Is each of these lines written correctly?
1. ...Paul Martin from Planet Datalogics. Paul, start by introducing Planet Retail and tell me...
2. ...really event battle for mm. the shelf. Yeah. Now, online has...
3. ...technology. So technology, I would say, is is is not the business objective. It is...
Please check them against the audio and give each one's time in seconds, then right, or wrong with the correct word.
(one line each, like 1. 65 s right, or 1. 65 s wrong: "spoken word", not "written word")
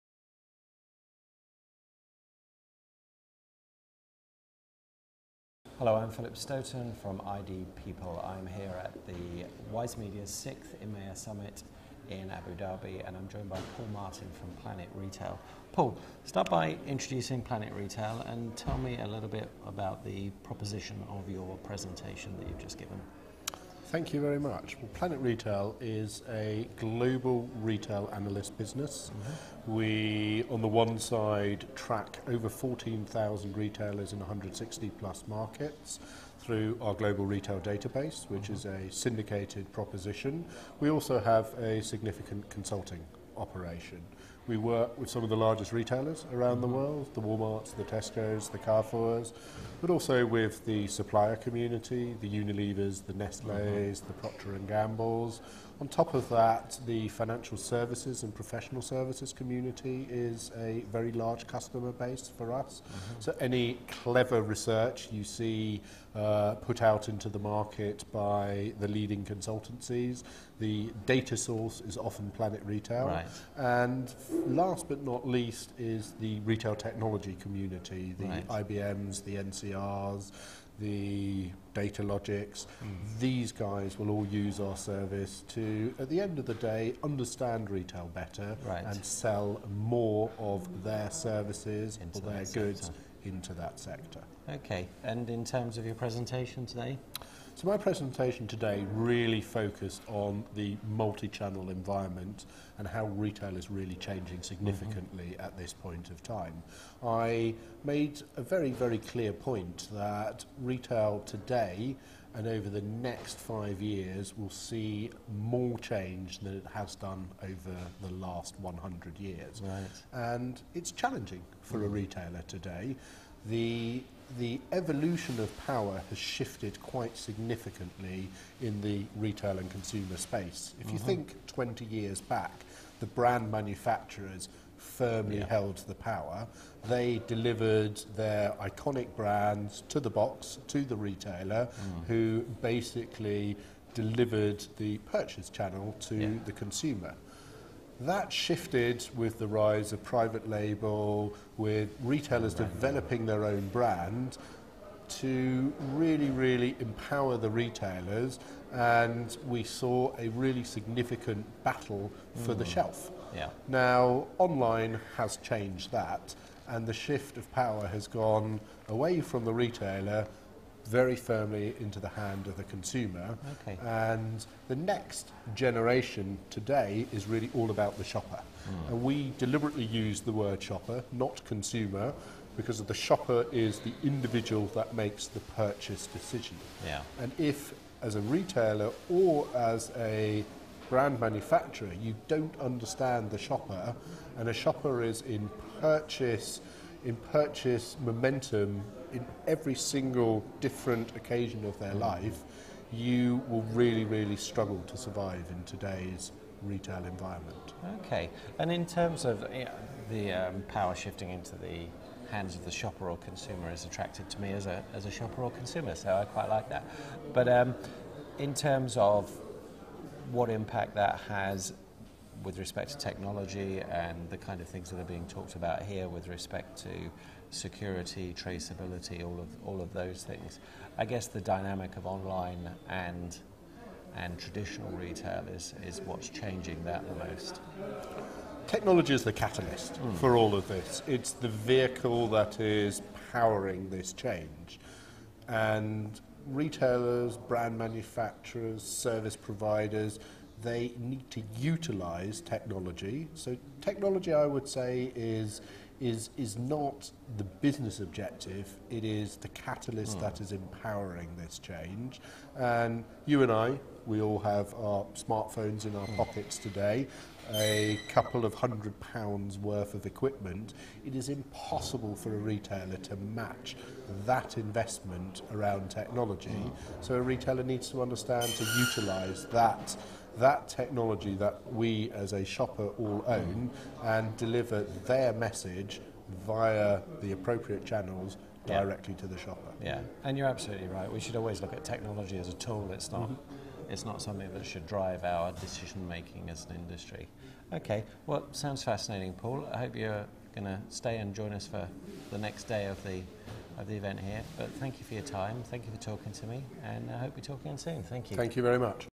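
1. 13 s wrong: "Retail", not "Datalogics"
2. 160 s wrong: "significant", not "event"
3. 252 s right.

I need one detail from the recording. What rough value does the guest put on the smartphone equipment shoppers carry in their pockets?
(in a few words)
A couple of hundred pounds.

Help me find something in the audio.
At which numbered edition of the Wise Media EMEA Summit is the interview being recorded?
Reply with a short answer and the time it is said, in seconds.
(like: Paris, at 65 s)
6th, at 10 s.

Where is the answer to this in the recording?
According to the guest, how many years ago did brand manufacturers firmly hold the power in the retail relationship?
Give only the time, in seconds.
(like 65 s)
131 s.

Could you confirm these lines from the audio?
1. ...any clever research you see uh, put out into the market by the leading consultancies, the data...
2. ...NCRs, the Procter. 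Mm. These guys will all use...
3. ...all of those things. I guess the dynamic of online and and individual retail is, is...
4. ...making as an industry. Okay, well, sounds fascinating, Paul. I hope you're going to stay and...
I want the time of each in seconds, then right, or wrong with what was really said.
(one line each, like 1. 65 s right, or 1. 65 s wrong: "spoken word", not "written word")
1. 63 s right
2. 79 s wrong: "Datalogics", not "Procter"
3. 229 s wrong: "traditional", not "individual"
4. 296 s right.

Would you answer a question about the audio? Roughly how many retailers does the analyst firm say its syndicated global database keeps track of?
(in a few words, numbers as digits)
14,000.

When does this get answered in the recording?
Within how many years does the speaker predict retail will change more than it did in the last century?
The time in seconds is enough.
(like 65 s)
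113 s.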